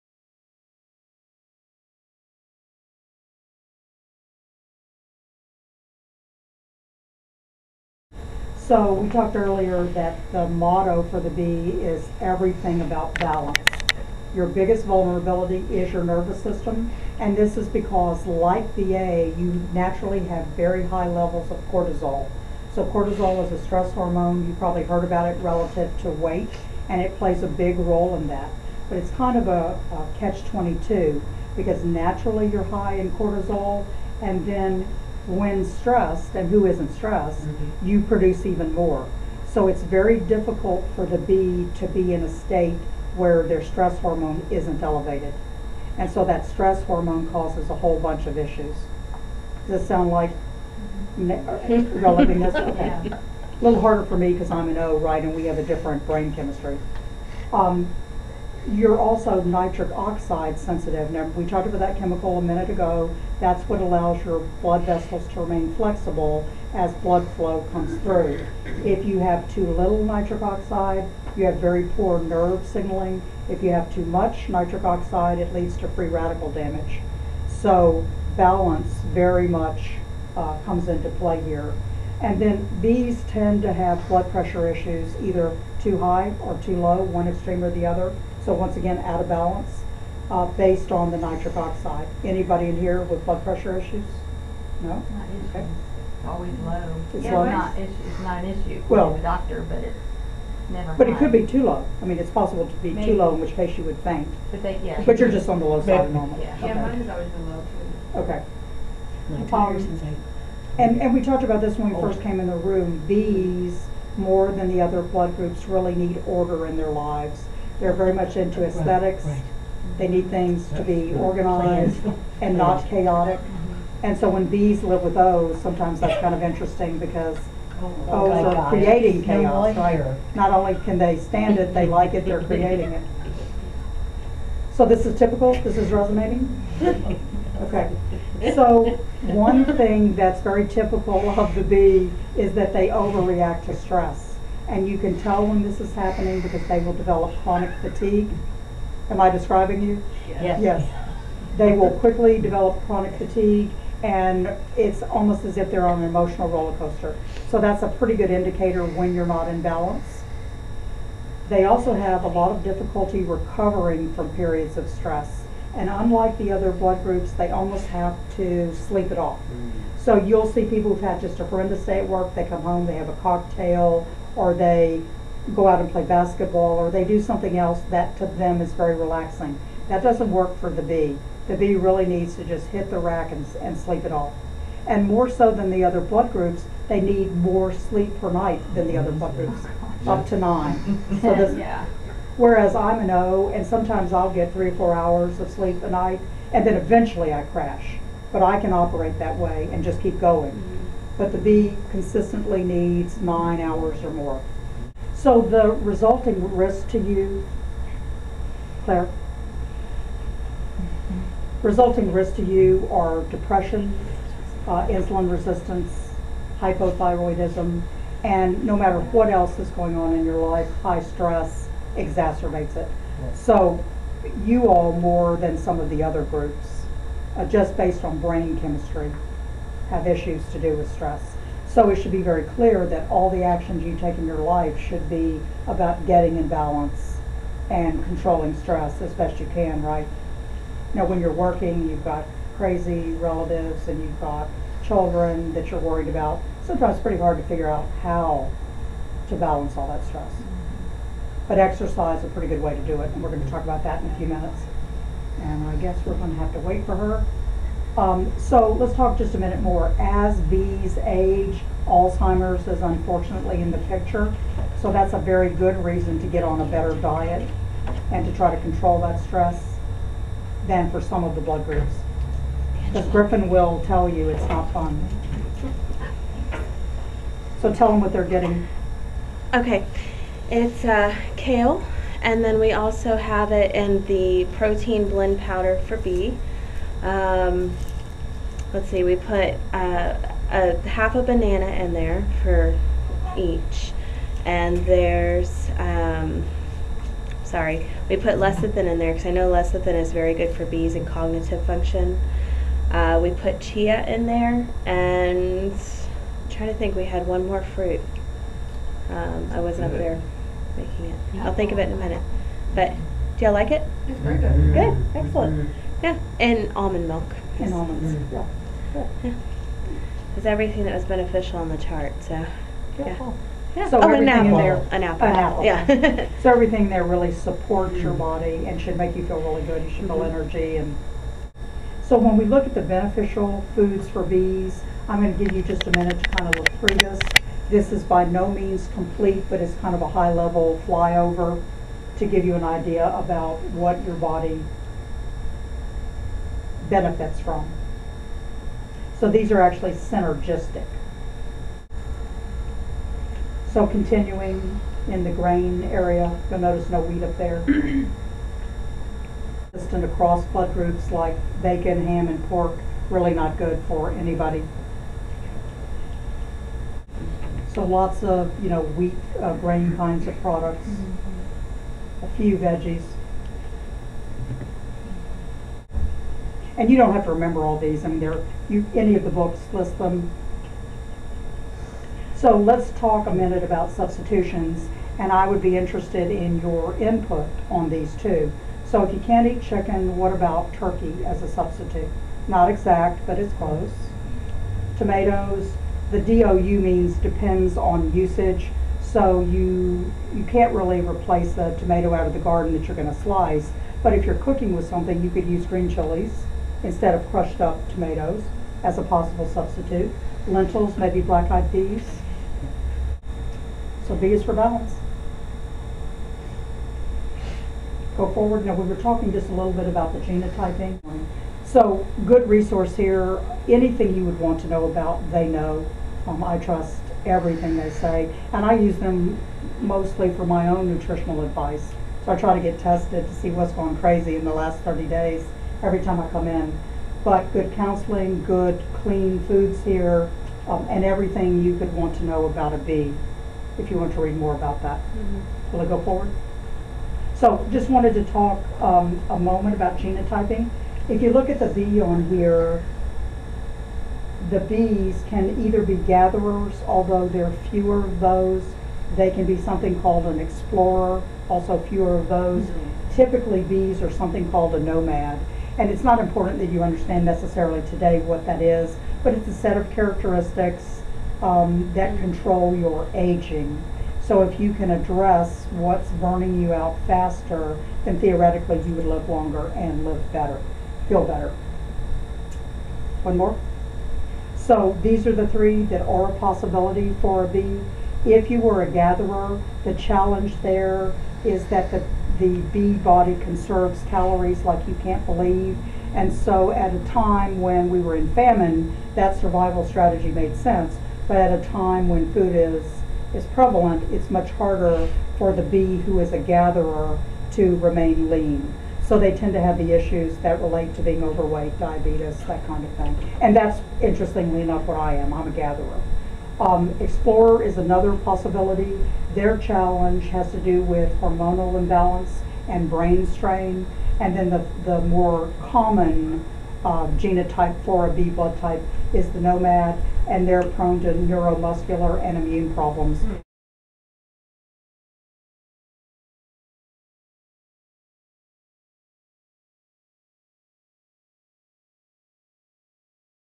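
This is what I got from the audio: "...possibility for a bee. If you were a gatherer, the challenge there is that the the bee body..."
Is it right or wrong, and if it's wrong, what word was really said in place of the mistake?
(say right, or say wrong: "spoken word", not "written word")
right.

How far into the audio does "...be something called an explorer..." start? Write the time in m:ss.
7:39.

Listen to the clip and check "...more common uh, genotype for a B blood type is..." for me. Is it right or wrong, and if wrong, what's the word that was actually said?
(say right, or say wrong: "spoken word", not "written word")
right.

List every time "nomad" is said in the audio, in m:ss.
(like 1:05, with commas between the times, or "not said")
7:44, 8:49.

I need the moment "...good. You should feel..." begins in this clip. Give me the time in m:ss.
5:29.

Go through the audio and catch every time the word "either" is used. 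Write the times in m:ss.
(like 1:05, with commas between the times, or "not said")
1:25, 7:35.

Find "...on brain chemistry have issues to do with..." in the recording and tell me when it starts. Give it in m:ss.
3:48.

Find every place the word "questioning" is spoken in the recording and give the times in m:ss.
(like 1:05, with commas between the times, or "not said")
not said.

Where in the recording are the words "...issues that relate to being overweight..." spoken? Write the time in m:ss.
8:29.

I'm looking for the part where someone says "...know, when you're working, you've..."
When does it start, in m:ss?
4:00.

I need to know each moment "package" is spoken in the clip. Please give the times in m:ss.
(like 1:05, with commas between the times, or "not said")
not said.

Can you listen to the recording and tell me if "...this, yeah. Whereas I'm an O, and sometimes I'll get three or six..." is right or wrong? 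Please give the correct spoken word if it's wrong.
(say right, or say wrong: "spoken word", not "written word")
wrong: "four", not "six".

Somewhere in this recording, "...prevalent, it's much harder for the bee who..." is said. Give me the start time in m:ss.
8:23.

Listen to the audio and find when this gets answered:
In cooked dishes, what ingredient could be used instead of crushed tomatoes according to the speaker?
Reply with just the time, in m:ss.
6:45.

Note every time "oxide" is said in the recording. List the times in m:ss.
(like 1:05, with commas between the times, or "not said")
0:59, 1:10, 1:14, 1:31.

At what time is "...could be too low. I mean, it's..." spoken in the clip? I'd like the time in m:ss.
1:41.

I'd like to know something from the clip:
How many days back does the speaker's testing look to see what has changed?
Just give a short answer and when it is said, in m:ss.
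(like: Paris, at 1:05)
30, at 7:14.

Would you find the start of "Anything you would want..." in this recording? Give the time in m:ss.
7:03.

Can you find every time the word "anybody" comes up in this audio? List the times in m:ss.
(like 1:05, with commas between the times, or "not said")
1:32, 6:04.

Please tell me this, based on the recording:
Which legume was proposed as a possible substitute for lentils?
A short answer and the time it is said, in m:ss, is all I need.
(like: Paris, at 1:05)
black-eyed peas, at 6:51.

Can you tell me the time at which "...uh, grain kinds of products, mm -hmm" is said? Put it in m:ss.
6:09.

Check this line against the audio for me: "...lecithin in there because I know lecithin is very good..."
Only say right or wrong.
right.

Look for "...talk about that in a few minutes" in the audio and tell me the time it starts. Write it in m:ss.
4:13.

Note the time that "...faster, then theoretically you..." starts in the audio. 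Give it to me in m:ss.
7:57.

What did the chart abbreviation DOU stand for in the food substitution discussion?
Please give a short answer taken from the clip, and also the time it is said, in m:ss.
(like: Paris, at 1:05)
depends on usage, at 6:37.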